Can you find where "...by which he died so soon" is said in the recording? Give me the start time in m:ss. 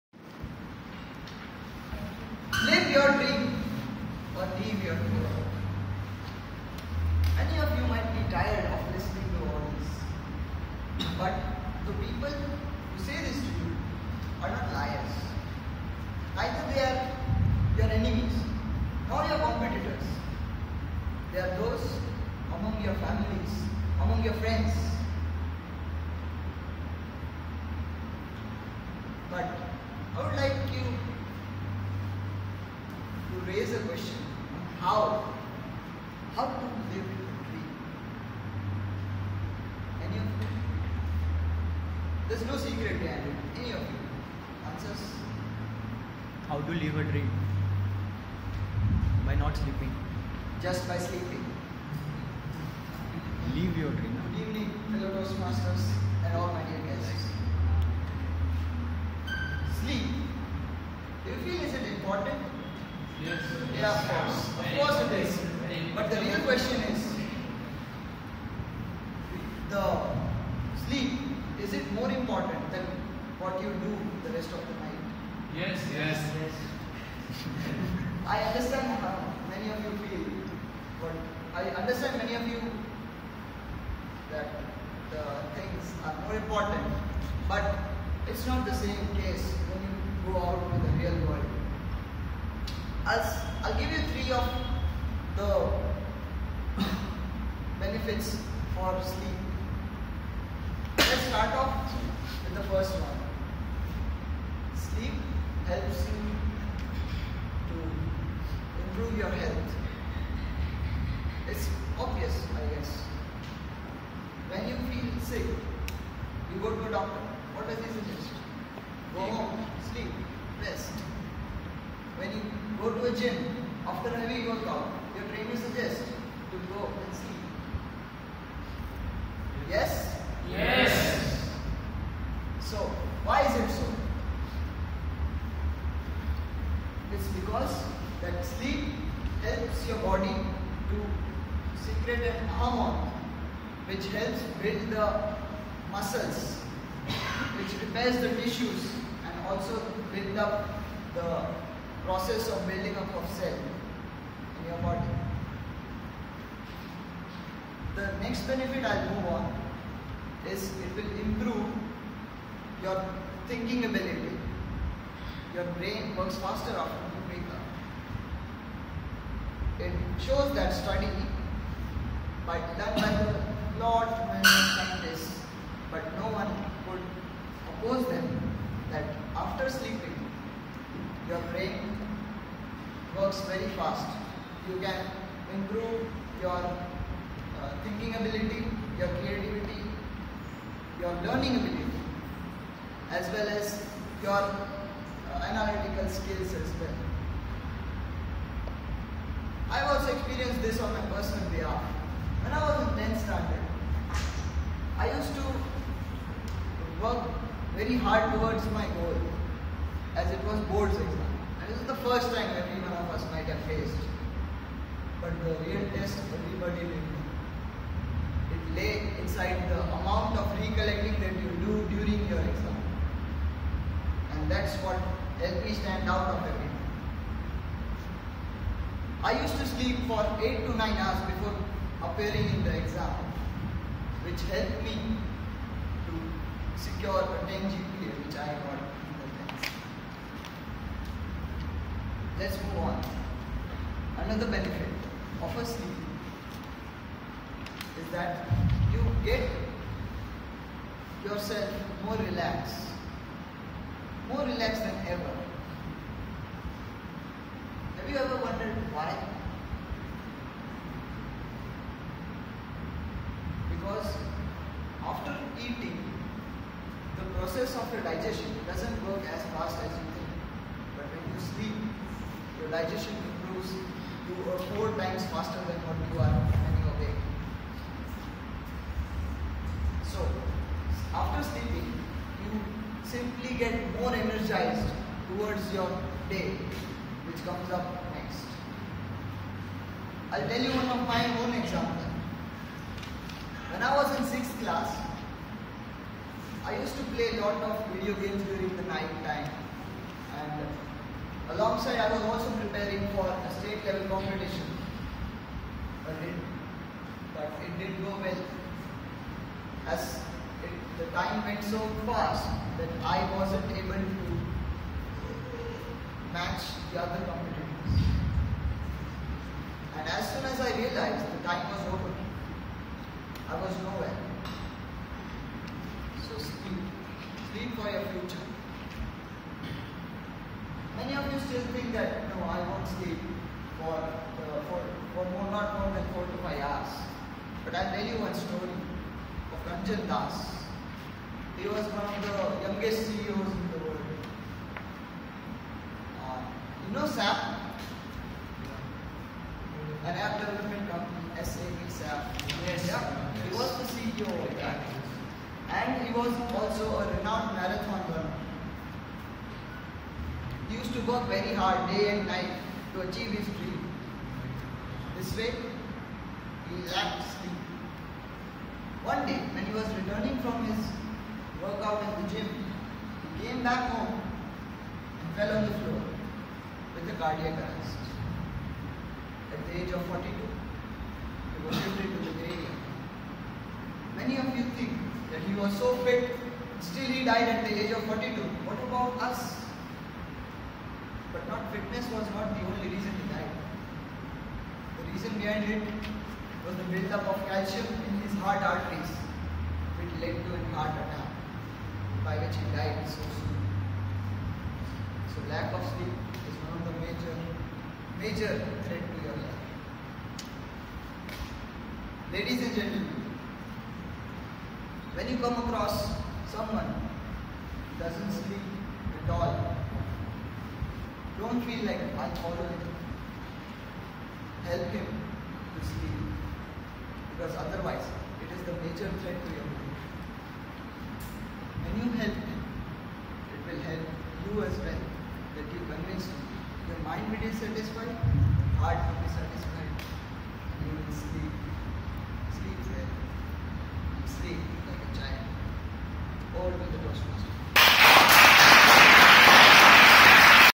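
6:42.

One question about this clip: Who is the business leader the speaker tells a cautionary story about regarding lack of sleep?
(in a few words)
Ranjan Das.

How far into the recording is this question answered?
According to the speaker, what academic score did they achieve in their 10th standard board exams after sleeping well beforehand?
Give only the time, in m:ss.
3:57.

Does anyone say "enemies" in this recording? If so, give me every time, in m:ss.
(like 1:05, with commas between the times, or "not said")
0:17.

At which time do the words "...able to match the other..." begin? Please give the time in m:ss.
5:13.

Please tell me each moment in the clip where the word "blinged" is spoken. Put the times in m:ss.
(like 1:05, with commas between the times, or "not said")
not said.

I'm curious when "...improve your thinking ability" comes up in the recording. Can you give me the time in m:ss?
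2:41.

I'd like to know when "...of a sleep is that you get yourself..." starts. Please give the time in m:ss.
4:05.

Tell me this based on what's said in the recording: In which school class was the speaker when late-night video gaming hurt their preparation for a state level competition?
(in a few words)
6th class.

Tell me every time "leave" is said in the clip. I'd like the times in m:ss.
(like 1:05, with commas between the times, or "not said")
0:04.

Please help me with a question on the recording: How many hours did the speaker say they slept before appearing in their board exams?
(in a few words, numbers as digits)
8 to 9 hours.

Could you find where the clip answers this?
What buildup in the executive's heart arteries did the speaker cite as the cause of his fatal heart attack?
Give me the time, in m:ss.
6:37.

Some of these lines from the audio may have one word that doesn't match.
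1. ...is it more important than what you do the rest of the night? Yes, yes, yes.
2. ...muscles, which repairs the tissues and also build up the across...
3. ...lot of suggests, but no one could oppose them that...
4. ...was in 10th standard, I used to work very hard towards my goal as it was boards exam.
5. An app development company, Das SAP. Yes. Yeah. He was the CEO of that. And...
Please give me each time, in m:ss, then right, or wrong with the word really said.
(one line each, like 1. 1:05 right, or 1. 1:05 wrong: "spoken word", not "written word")
1. 1:11 right
2. 2:25 wrong: "process", not "across"
3. 2:53 wrong: "scientists", not "suggests"
4. 3:22 right
5. 5:50 wrong: "SAP", not "Das".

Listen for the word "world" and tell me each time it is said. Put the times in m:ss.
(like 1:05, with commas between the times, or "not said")
1:31, 5:43.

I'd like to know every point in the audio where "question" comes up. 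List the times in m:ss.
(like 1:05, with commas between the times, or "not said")
0:33, 1:06.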